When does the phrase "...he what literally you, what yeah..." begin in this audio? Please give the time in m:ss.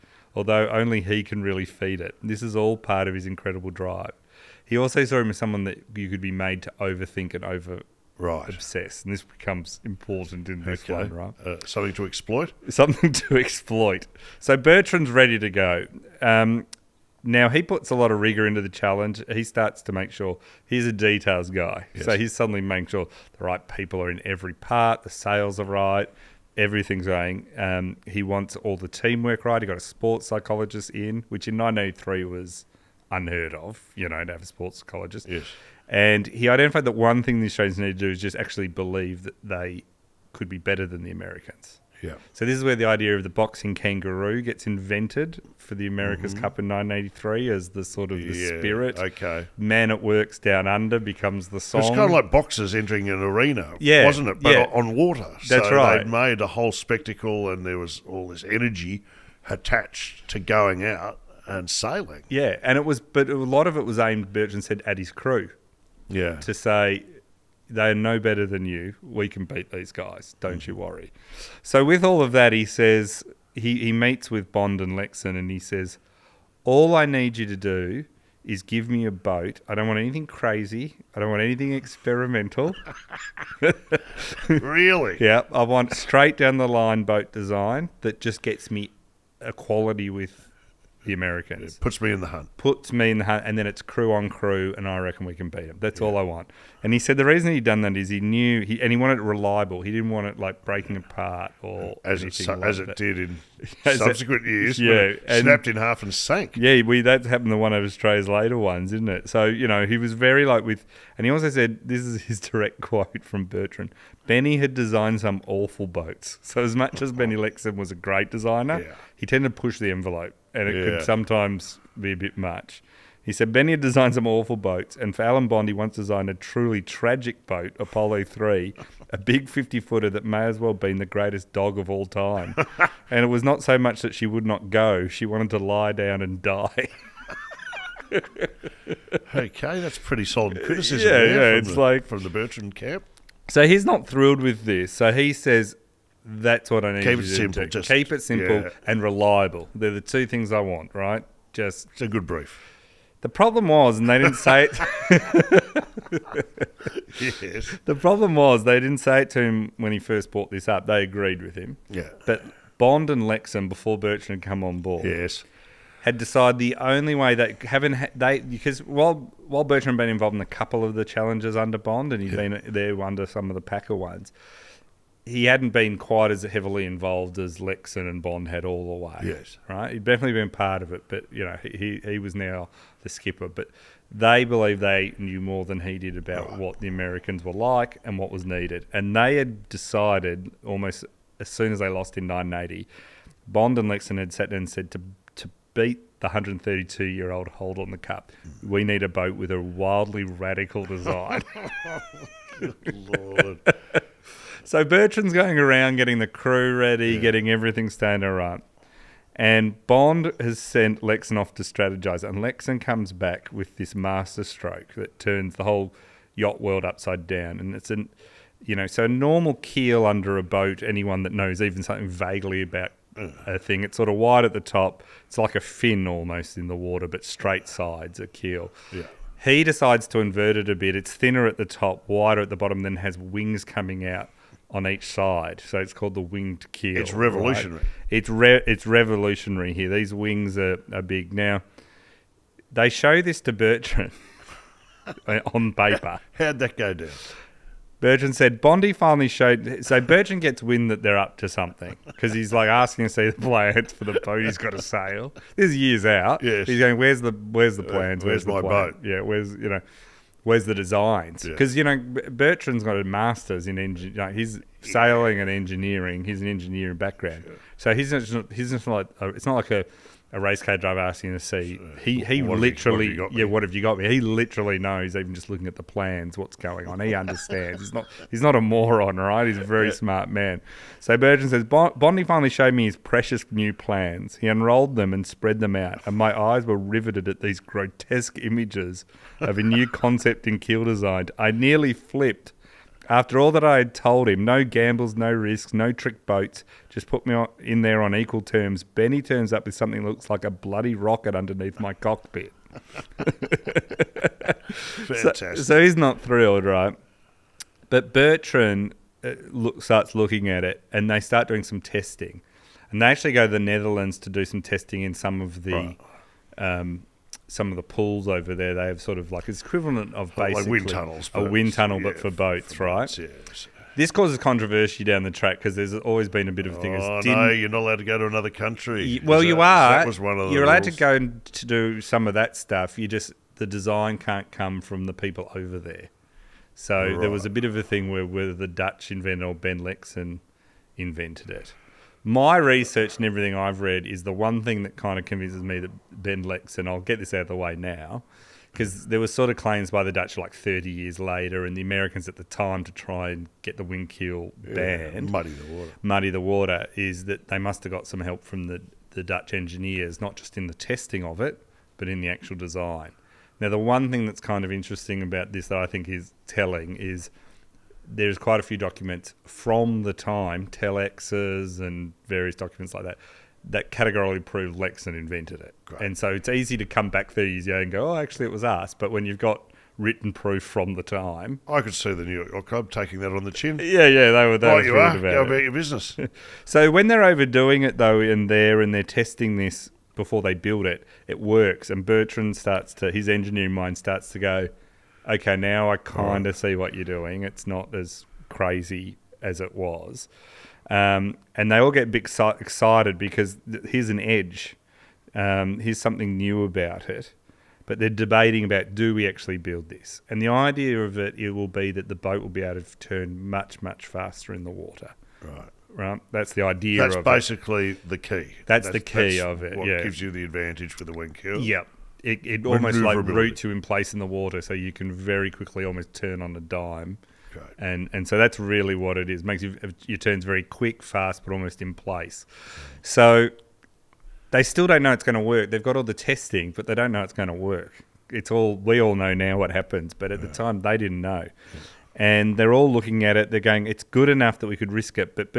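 4:32.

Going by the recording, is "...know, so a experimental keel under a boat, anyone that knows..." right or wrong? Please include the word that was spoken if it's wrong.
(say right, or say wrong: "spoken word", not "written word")
wrong: "normal", not "experimental".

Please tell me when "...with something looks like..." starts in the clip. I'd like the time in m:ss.
4:59.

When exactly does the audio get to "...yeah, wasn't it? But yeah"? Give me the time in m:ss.
0:53.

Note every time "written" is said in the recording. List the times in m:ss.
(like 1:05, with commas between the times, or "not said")
6:19.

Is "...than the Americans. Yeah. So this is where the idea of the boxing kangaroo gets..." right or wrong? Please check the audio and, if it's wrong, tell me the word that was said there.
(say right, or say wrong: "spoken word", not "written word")
right.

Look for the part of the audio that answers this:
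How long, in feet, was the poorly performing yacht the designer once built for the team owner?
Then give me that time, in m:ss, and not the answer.
2:09.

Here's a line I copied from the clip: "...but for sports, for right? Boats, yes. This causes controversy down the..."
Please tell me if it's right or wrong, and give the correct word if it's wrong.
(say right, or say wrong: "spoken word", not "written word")
wrong: "boats", not "sports".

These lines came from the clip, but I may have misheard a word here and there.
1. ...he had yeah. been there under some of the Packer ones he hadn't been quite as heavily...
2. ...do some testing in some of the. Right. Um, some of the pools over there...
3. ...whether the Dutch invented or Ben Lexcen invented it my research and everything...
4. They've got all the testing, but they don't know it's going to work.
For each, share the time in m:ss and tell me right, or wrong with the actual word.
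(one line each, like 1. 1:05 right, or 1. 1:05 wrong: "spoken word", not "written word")
1. 2:52 right
2. 5:14 right
3. 5:38 right
4. 7:15 right.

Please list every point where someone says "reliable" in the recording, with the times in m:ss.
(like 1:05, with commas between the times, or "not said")
1:39, 2:29.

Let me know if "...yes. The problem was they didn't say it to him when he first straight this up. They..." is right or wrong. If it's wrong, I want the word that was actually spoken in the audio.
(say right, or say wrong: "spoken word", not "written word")
wrong: "brought", not "straight".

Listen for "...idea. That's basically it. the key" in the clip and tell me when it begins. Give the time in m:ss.
6:56.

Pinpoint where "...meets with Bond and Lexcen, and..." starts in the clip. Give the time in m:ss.
1:13.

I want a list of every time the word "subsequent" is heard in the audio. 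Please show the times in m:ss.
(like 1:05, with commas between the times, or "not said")
1:43.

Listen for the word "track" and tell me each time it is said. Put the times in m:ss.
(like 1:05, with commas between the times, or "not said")
5:25.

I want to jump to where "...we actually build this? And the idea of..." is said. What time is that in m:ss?
6:49.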